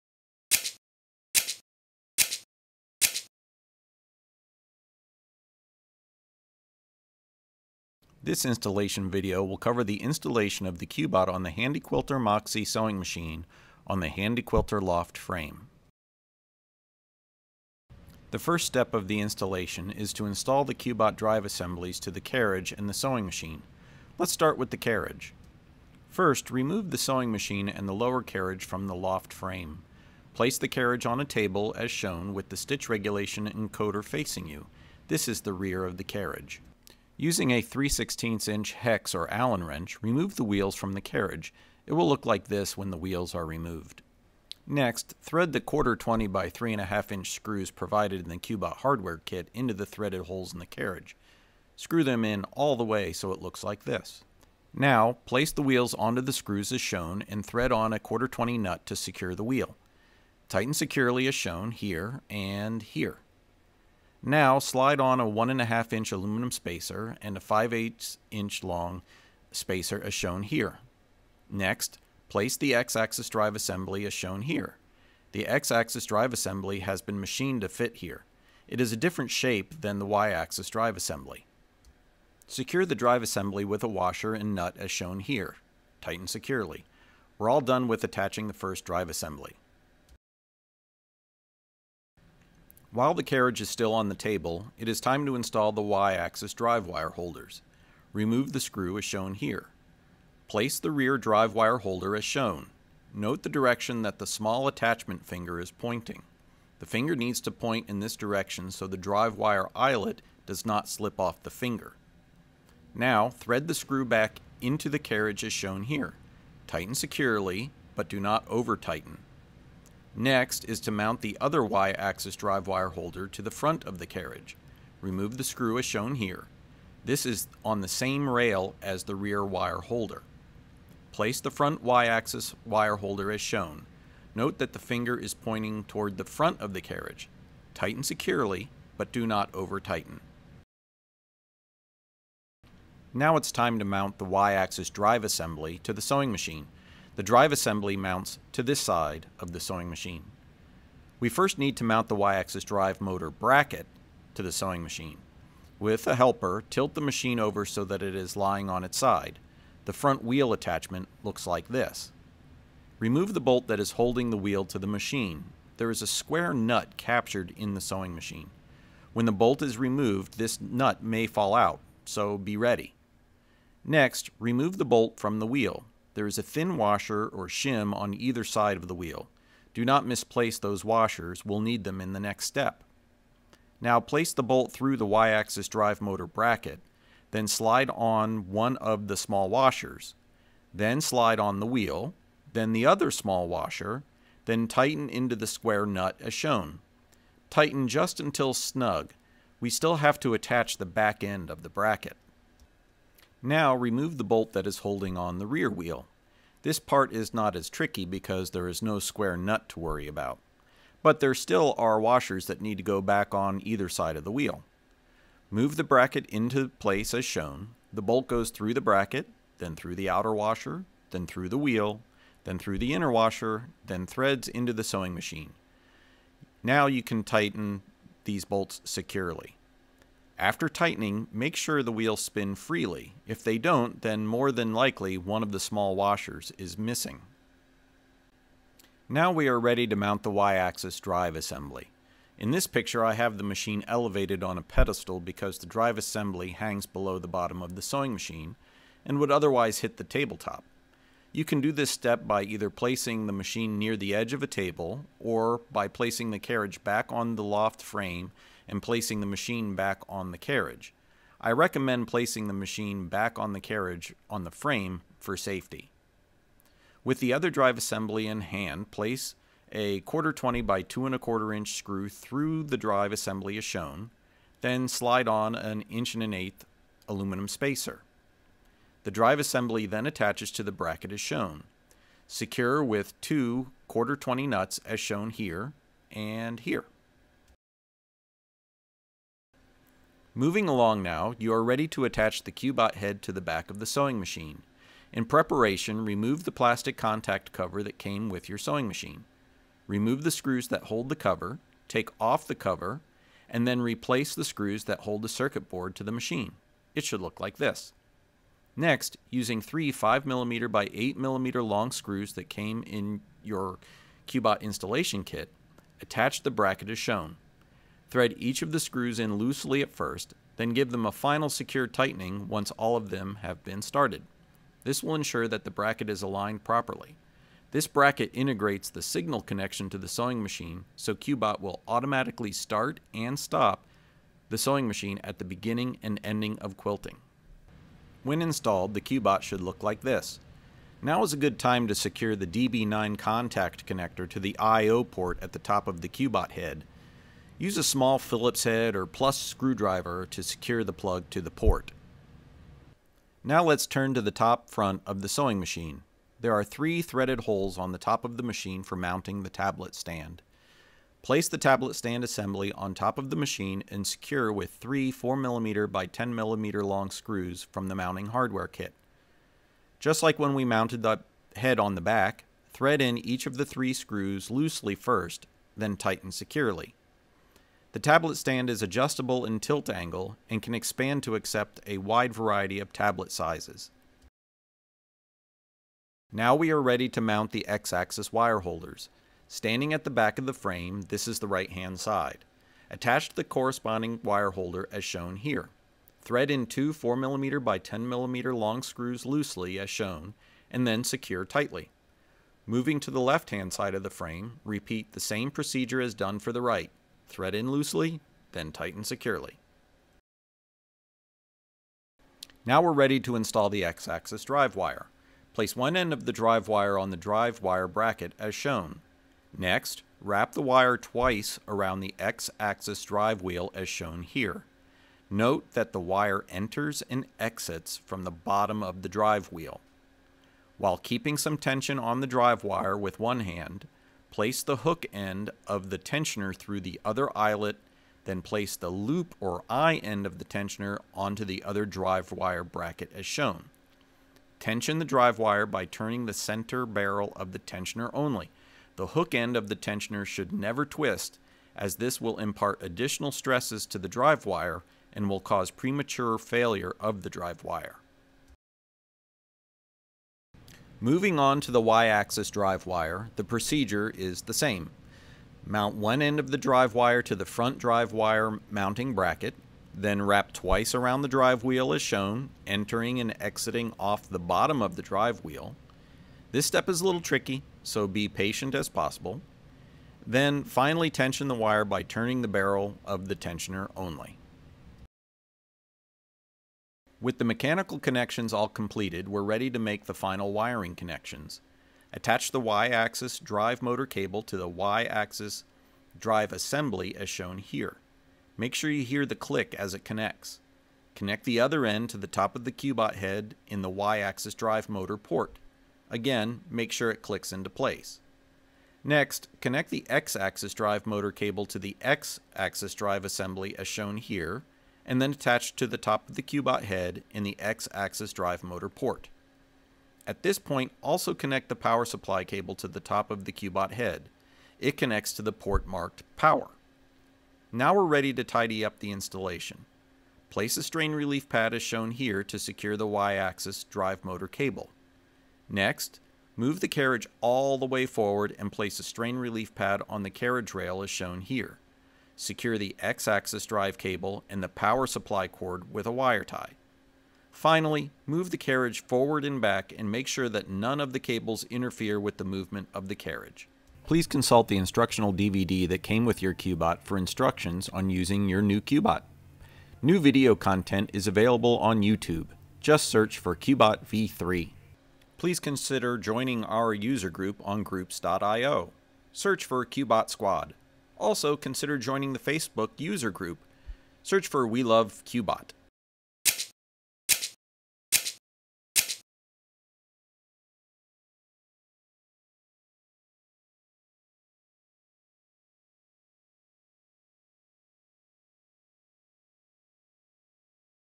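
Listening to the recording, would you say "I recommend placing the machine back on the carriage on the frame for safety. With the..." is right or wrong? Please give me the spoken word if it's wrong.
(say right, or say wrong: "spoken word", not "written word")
right.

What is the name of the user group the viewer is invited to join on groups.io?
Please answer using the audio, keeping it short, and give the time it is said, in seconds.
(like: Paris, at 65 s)
Qbot Squad, at 569 s.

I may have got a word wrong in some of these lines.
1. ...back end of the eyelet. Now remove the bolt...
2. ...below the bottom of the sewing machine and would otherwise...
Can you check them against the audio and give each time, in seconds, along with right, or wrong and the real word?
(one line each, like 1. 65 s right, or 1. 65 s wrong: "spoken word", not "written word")
1. 200 s wrong: "bracket", not "eyelet"
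2. 246 s right.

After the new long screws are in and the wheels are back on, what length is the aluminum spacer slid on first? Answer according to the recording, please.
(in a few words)
1.5 inch.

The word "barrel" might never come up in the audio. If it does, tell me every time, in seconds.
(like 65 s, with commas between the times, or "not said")
446 s, 482 s.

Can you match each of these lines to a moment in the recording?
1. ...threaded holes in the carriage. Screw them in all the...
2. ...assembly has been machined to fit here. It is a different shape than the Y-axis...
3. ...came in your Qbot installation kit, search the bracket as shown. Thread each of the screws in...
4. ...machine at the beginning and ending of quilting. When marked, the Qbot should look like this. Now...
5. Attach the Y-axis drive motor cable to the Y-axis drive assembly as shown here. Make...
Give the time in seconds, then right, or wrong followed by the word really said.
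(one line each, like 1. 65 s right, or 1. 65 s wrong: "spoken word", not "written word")
1. 49 s right
2. 76 s right
3. 312 s wrong: "attach", not "search"
4. 334 s wrong: "installed", not "marked"
5. 492 s right.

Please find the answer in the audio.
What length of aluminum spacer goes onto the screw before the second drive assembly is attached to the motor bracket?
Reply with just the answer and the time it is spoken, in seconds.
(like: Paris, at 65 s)
1 1/8 inch, at 275 s.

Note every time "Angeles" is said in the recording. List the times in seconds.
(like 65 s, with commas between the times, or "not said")
not said.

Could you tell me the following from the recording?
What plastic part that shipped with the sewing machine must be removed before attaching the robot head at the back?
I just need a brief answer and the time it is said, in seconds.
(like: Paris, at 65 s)
contact cover, at 296 s.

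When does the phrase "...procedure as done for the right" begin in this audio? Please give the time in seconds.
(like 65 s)
405 s.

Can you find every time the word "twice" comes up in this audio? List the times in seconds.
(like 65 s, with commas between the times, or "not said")
420 s, 470 s.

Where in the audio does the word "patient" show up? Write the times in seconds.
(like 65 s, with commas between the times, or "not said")
478 s.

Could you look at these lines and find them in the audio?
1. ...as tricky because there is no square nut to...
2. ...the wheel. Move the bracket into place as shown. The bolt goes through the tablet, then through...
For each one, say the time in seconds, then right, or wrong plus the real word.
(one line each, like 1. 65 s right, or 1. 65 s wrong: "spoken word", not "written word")
1. 207 s right
2. 214 s wrong: "bracket", not "tablet".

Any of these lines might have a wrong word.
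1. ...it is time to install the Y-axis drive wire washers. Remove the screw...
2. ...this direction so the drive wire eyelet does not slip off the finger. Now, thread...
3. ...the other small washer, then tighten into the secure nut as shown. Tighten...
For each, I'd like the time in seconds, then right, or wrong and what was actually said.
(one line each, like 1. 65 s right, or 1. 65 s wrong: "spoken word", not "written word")
1. 94 s wrong: "holders", not "washers"
2. 108 s right
3. 192 s wrong: "square", not "secure".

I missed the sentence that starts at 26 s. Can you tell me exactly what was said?
First, remove the sewing machine and the lower carriage from the loft frame.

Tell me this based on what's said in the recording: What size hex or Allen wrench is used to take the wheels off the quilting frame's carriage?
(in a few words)
3/16 inch.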